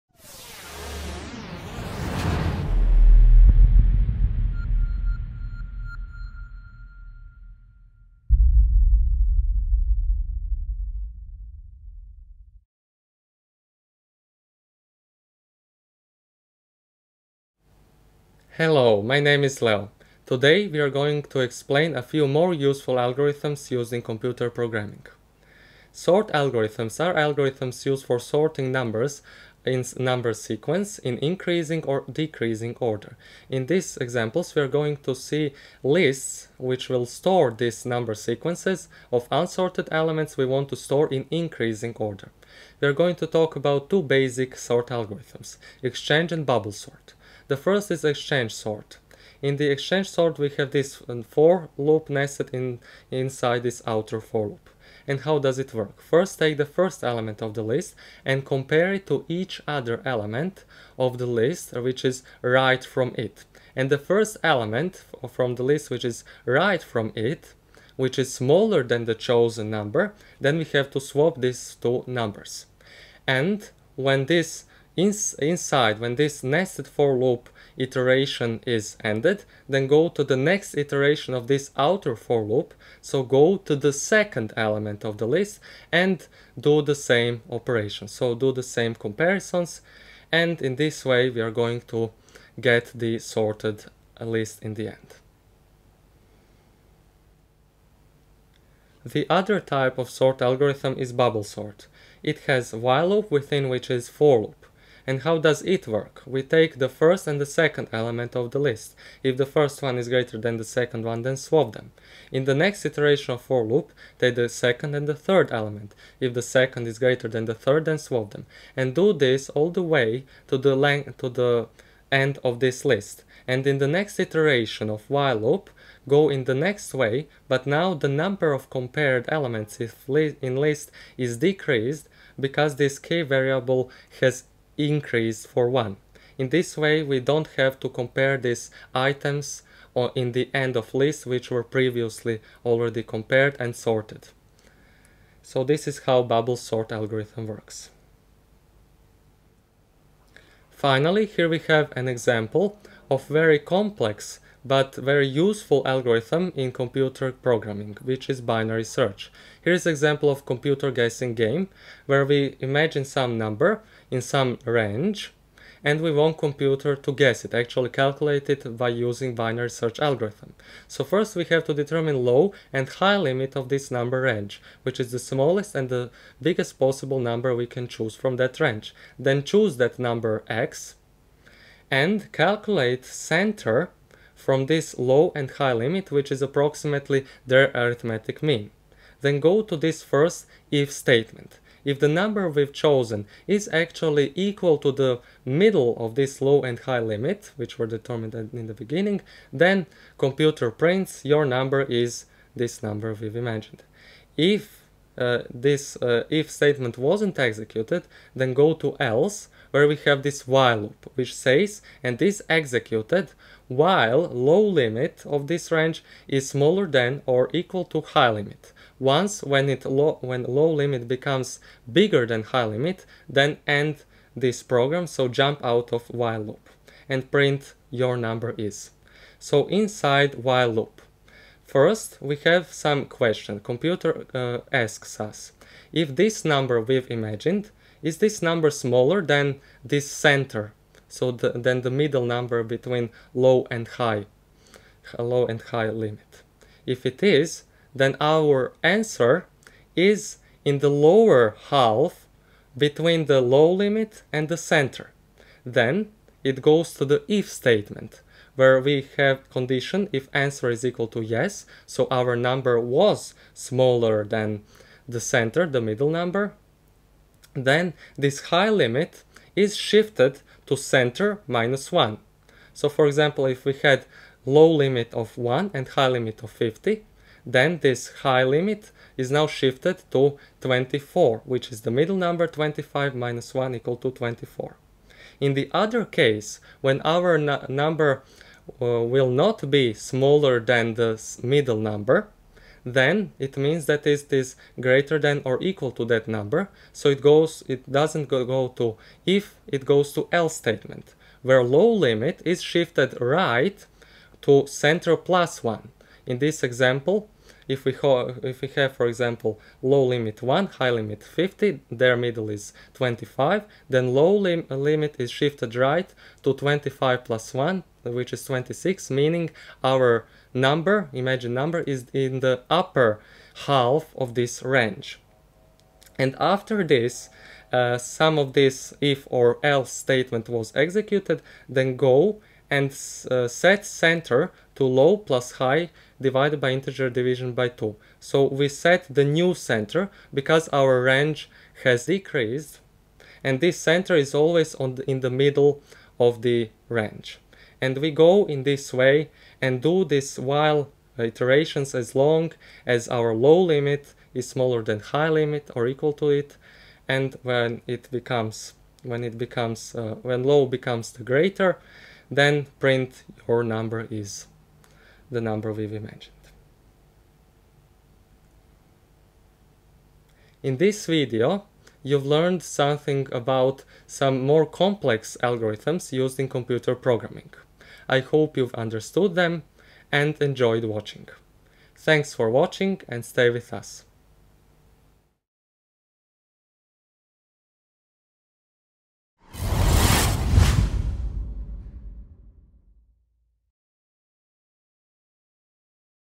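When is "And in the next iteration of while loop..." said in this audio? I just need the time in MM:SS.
02:03.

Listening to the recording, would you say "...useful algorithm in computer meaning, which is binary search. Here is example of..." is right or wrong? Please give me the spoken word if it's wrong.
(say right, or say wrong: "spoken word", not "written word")
wrong: "programming", not "meaning".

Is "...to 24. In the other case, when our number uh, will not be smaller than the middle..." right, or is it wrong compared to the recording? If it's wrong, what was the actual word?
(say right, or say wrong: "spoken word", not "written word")
right.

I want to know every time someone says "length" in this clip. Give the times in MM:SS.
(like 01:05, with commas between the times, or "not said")
02:00.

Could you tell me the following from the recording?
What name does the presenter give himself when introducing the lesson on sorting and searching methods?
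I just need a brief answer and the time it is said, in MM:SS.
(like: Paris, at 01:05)
Leo, at 00:19.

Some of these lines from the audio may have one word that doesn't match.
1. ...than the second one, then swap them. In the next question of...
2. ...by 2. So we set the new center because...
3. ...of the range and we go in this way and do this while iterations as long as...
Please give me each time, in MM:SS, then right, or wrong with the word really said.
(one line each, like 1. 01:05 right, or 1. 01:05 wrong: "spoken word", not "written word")
1. 01:50 wrong: "iteration", not "question"
2. 05:37 right
3. 05:46 right.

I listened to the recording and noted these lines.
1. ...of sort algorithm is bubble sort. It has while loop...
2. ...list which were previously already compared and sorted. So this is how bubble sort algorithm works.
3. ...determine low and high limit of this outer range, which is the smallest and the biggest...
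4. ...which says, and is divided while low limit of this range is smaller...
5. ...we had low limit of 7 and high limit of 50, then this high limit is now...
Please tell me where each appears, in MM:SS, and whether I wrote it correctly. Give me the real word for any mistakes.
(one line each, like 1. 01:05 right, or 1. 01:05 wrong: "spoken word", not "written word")
1. 01:39 right
2. 02:20 right
3. 02:51 wrong: "number", not "outer"
4. 03:31 wrong: "executed", not "divided"
5. 04:33 wrong: "1", not "7".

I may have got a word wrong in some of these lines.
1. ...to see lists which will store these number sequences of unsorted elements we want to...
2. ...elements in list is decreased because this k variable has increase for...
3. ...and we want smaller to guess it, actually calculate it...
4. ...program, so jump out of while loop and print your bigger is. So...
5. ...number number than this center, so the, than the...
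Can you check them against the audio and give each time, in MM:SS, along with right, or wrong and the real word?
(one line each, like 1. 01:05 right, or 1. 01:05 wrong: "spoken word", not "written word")
1. 00:34 right
2. 02:09 right
3. 02:45 wrong: "computer", not "smaller"
4. 03:44 wrong: "number", not "bigger"
5. 03:58 wrong: "smaller", not "number".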